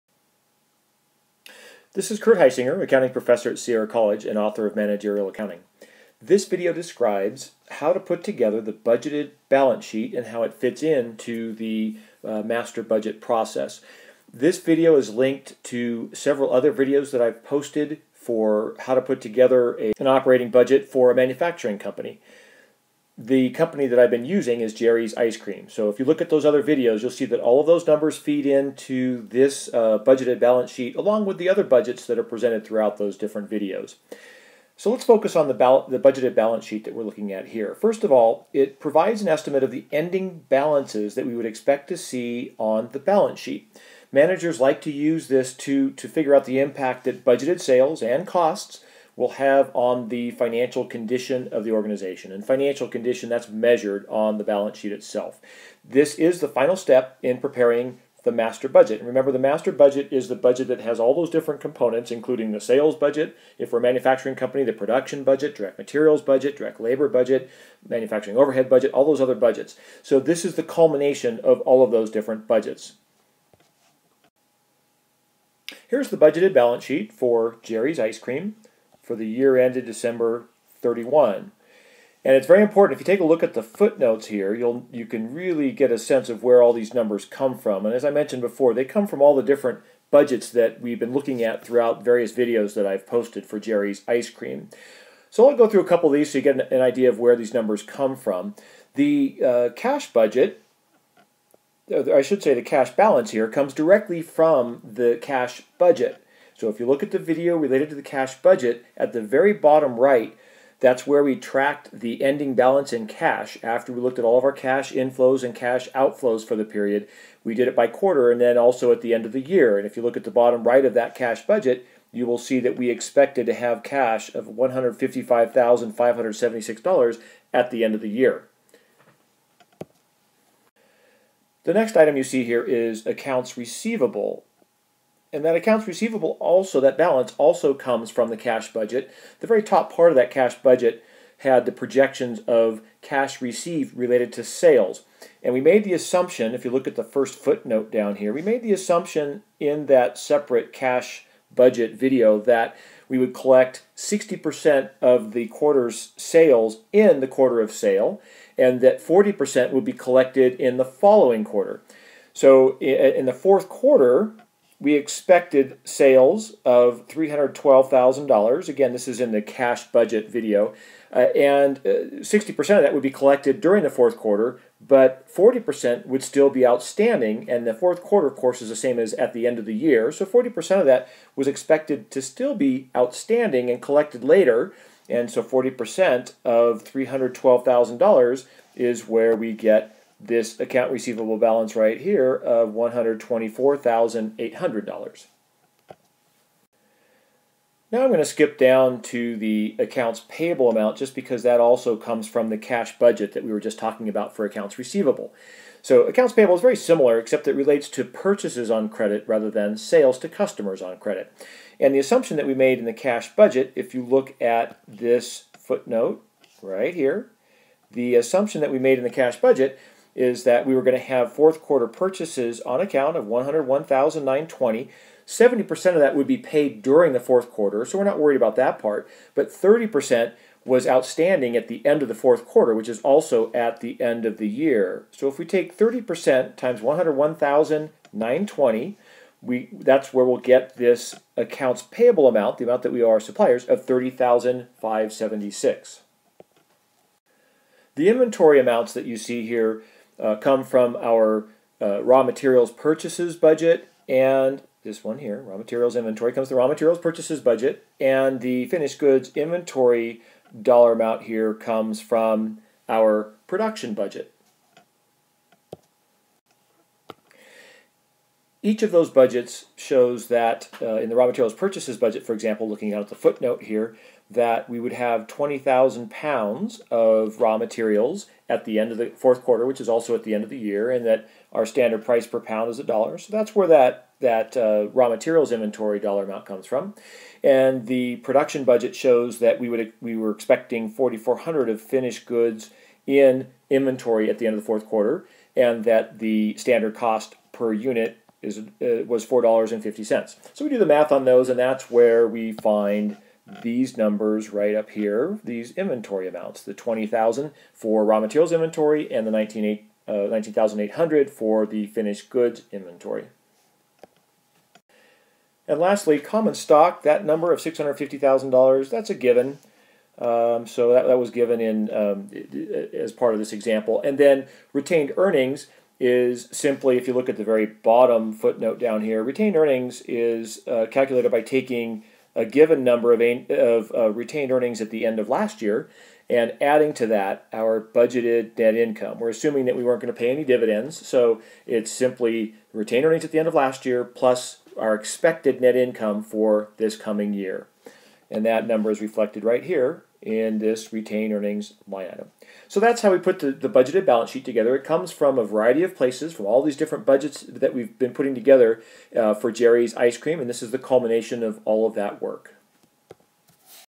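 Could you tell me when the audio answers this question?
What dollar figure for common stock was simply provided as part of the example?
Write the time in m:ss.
5:17.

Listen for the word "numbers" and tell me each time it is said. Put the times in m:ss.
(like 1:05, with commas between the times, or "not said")
0:27, 1:26, 1:37, 5:03, 5:17, 5:32, 5:48.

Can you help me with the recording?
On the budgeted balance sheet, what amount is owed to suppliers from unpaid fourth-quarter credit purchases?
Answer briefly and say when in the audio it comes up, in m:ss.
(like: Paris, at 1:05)
30,576, at 4:03.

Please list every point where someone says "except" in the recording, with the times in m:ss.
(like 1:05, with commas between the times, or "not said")
3:27.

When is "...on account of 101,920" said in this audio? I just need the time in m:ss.
3:42.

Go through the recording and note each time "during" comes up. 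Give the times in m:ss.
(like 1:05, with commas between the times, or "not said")
2:53, 3:46.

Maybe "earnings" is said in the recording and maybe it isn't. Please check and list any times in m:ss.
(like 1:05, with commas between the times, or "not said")
5:25, 5:29, 5:34, 5:43, 5:51.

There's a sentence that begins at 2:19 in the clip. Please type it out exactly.
The very top part of that cash budget had the projections of cash received related to sales.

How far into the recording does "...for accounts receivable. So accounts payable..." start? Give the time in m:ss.
3:24.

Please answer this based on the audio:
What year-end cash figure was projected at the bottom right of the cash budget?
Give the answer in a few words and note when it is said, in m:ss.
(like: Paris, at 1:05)
$155,576, at 2:04.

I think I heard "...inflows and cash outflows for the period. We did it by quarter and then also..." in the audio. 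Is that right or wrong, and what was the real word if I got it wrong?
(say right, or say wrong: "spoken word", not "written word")
right.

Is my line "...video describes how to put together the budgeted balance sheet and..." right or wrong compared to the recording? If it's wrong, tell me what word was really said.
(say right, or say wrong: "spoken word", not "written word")
right.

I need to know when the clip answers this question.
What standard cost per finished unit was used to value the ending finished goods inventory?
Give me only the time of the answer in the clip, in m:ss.
4:59.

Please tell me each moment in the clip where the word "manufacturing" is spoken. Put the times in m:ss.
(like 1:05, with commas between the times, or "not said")
0:21, 1:03, 1:07.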